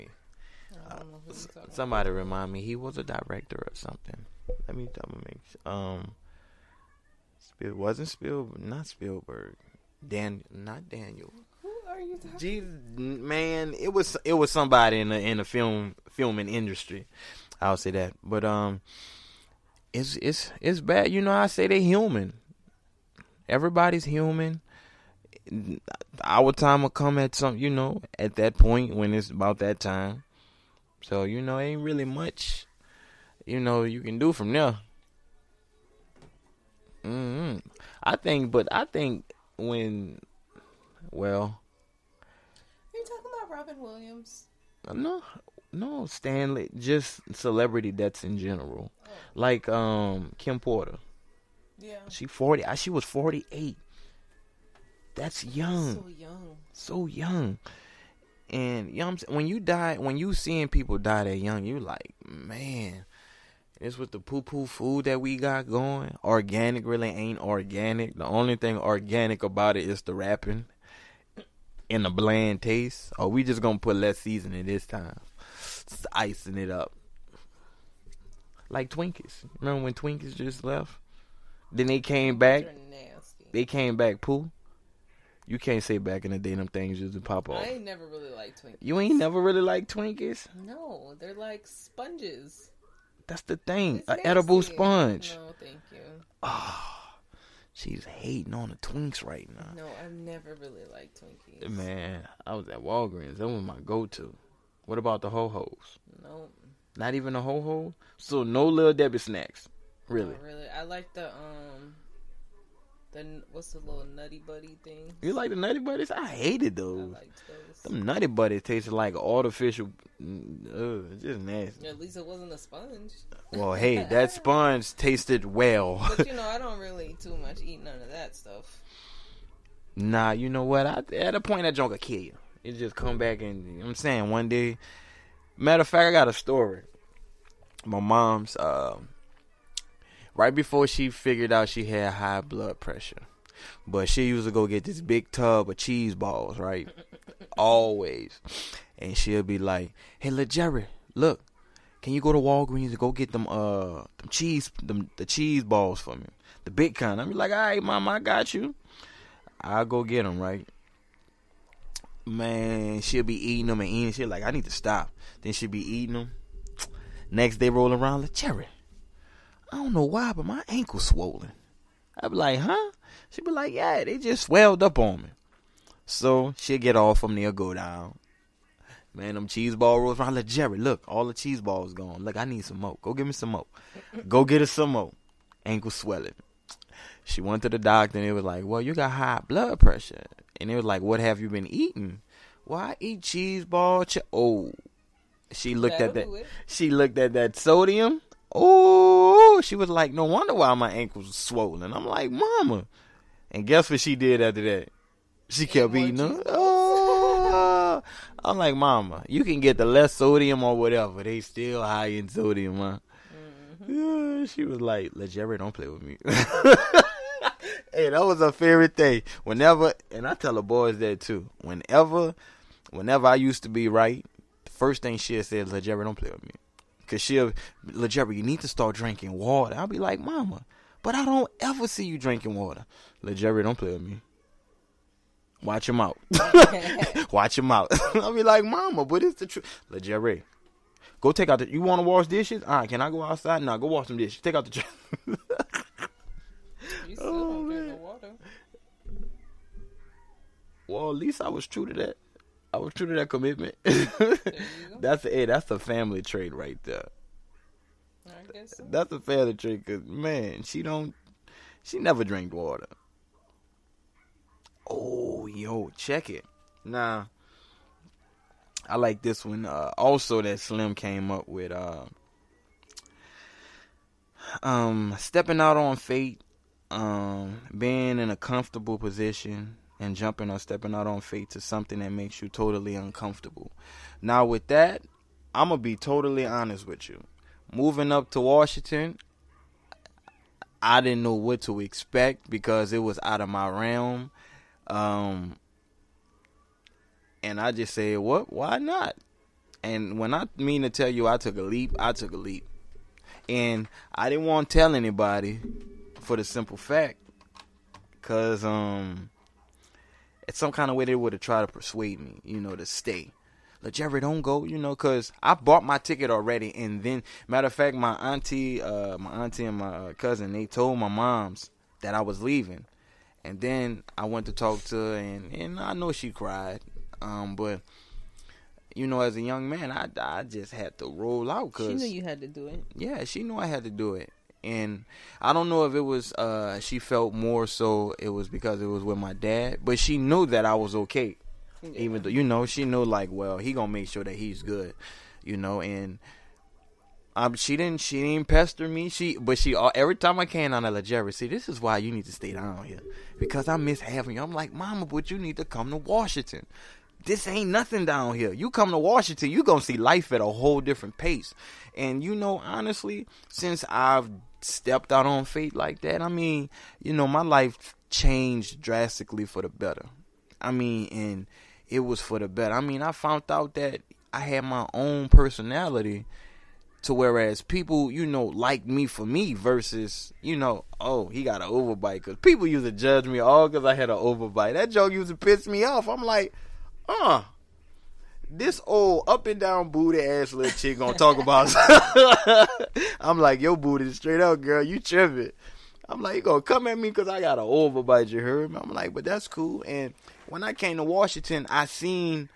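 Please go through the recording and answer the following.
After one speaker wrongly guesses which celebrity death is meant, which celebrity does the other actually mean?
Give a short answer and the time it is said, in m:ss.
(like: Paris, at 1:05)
Stan Lee, at 0:46.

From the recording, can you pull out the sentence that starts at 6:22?
Because people used to judge me all because I had an overbite.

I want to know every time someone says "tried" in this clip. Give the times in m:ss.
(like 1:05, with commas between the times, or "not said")
5:11.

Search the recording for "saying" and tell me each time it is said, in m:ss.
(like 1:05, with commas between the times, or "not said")
0:59, 2:13.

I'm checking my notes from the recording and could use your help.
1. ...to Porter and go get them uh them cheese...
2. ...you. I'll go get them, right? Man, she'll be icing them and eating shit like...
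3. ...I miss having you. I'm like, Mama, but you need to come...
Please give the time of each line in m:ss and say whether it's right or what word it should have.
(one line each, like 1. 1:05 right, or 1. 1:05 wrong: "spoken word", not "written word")
1. 2:32 wrong: "Walgreens", not "Porter"
2. 2:38 wrong: "eating", not "icing"
3. 5:53 right.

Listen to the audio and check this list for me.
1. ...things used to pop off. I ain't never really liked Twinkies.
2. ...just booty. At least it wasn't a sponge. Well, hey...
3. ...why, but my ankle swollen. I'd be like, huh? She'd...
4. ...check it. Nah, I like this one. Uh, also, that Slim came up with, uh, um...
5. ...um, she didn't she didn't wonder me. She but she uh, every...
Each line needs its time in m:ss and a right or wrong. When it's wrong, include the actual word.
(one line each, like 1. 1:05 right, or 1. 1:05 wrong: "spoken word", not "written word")
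1. 1:26 right
2. 2:01 wrong: "nasty", not "booty"
3. 2:50 right
4. 4:25 right
5. 5:47 wrong: "pester", not "wonder".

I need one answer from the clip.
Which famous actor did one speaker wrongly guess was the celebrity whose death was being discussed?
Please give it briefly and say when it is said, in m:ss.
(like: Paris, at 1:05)
Robin Williams, at 0:43.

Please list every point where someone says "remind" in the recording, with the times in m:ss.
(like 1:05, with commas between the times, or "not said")
0:02.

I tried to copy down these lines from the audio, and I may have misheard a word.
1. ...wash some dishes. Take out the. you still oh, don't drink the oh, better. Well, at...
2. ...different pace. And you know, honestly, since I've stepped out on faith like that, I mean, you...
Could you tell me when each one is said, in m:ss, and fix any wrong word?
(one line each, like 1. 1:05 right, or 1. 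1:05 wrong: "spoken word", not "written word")
1. 4:03 wrong: "water", not "better"
2. 6:00 right.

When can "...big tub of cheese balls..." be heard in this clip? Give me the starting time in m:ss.
2:24.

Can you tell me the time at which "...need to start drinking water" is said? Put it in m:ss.
3:48.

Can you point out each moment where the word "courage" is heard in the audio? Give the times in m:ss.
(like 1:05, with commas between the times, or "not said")
not said.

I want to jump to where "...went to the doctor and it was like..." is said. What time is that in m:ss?
3:07.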